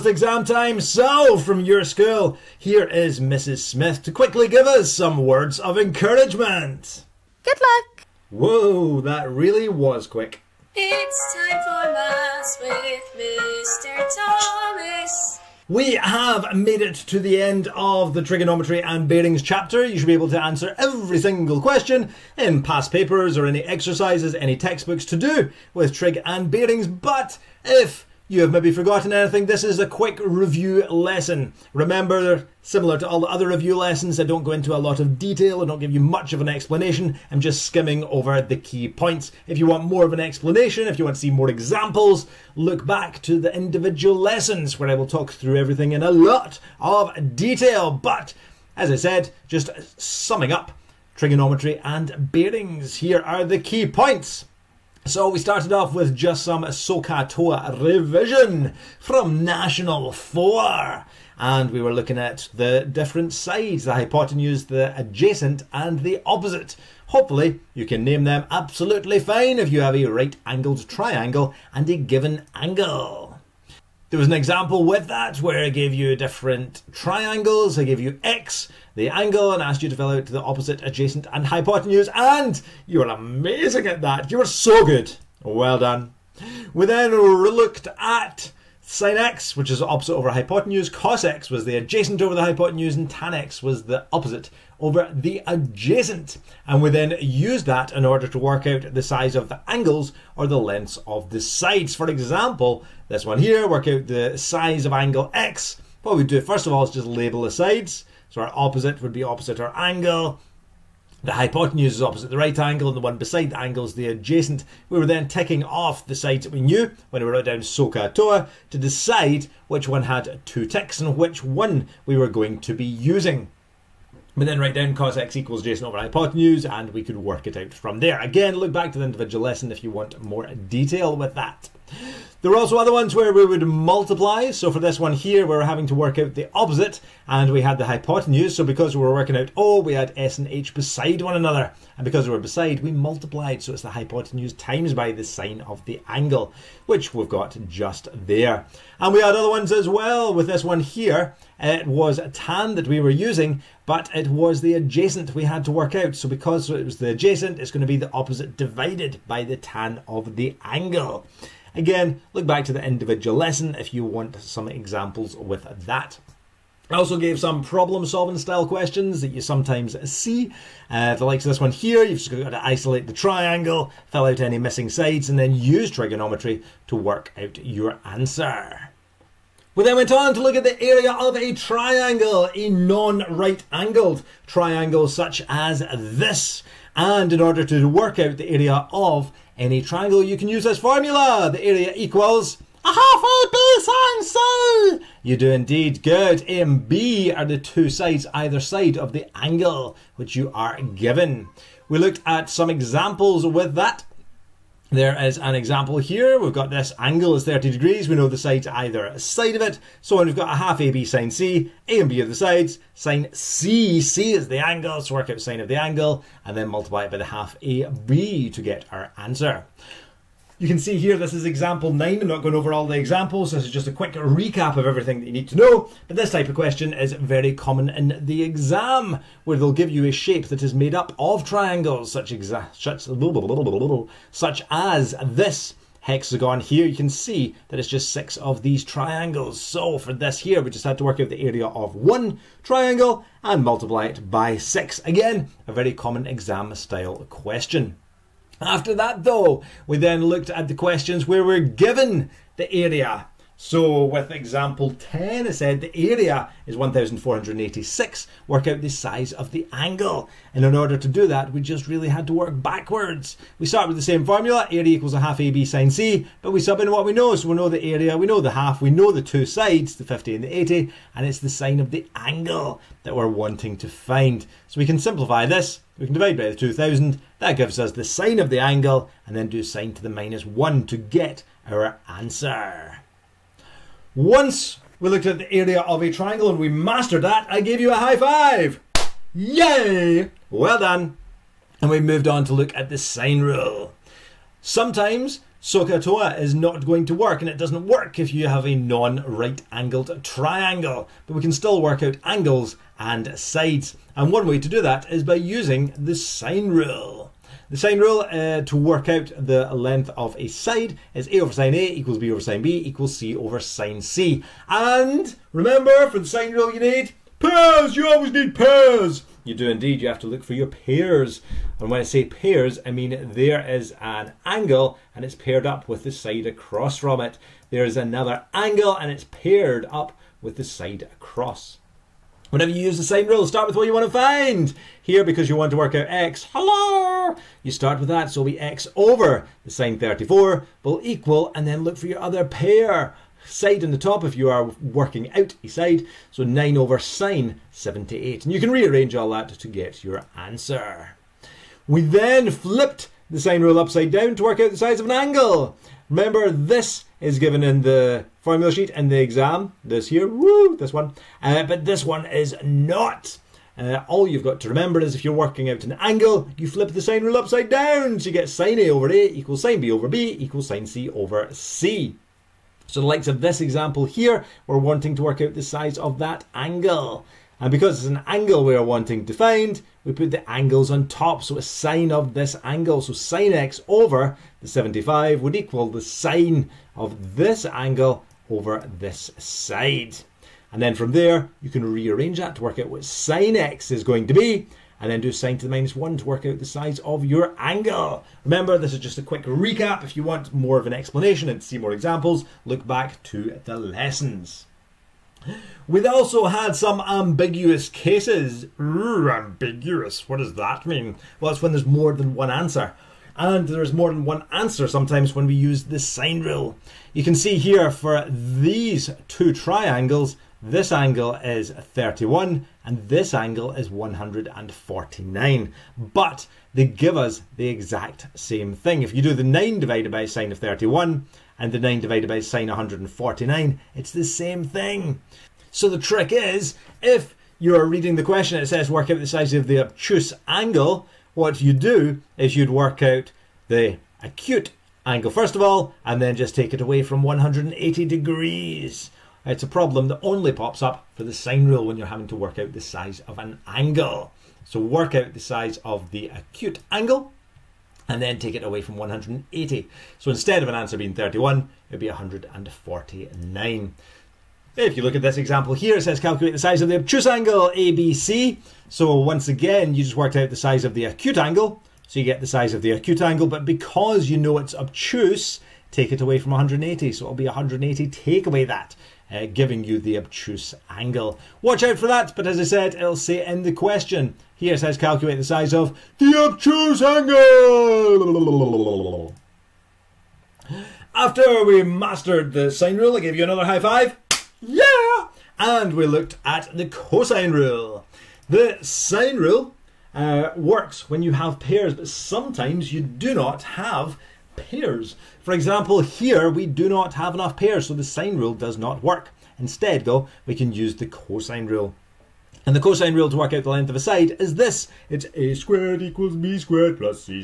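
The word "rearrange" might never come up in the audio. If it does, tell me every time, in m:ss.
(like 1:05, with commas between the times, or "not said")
5:48, 6:31.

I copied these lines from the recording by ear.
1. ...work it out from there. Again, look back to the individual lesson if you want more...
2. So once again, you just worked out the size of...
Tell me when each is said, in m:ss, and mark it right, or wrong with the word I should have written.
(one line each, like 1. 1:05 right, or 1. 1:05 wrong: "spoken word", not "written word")
1. 2:07 right
2. 7:48 right.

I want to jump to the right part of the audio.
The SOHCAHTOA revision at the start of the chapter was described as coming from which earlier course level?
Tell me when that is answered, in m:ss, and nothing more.
0:59.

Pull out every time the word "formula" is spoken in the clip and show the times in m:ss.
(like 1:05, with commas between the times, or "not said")
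3:10, 4:24, 5:58.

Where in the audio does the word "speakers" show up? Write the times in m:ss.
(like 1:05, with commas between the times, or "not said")
not said.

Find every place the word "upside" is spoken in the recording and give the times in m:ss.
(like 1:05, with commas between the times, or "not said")
5:53, 6:07.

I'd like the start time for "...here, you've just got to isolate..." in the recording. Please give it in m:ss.
2:51.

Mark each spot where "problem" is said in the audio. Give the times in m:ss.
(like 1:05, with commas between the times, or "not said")
2:47, 7:29.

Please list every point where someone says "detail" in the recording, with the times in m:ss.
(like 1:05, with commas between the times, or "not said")
0:35, 0:47, 2:10.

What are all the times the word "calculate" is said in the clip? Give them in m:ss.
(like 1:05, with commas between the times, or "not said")
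7:46, 8:04.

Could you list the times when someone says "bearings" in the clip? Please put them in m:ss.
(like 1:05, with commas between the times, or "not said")
0:19, 0:26, 0:52.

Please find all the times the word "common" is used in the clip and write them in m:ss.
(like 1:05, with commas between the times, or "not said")
3:47, 4:05.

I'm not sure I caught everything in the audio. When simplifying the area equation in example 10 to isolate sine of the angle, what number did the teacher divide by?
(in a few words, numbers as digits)
2000.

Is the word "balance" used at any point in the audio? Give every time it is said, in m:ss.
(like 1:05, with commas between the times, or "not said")
not said.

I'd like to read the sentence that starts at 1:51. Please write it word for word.
The hypotenuse is opposite the right angle and the one beside the angle is the adjacent.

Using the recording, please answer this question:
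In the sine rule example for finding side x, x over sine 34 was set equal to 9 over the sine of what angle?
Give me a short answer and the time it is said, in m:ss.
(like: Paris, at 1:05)
78 degrees, at 5:47.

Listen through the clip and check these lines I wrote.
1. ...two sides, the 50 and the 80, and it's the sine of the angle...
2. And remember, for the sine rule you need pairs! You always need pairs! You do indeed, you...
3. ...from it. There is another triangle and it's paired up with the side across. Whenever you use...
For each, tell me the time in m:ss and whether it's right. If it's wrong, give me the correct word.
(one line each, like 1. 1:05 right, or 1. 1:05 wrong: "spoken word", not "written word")
1. 4:29 right
2. 5:14 right
3. 5:26 wrong: "angle", not "triangle".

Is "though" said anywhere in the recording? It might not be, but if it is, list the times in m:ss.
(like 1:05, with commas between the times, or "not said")
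4:09, 8:30.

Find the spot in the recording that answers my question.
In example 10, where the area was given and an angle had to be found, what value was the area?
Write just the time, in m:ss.
4:16.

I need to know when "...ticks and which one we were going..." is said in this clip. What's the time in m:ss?
2:00.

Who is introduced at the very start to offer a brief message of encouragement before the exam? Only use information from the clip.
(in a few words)
Mrs. Smith.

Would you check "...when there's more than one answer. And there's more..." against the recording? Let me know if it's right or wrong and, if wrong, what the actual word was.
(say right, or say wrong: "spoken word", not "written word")
right.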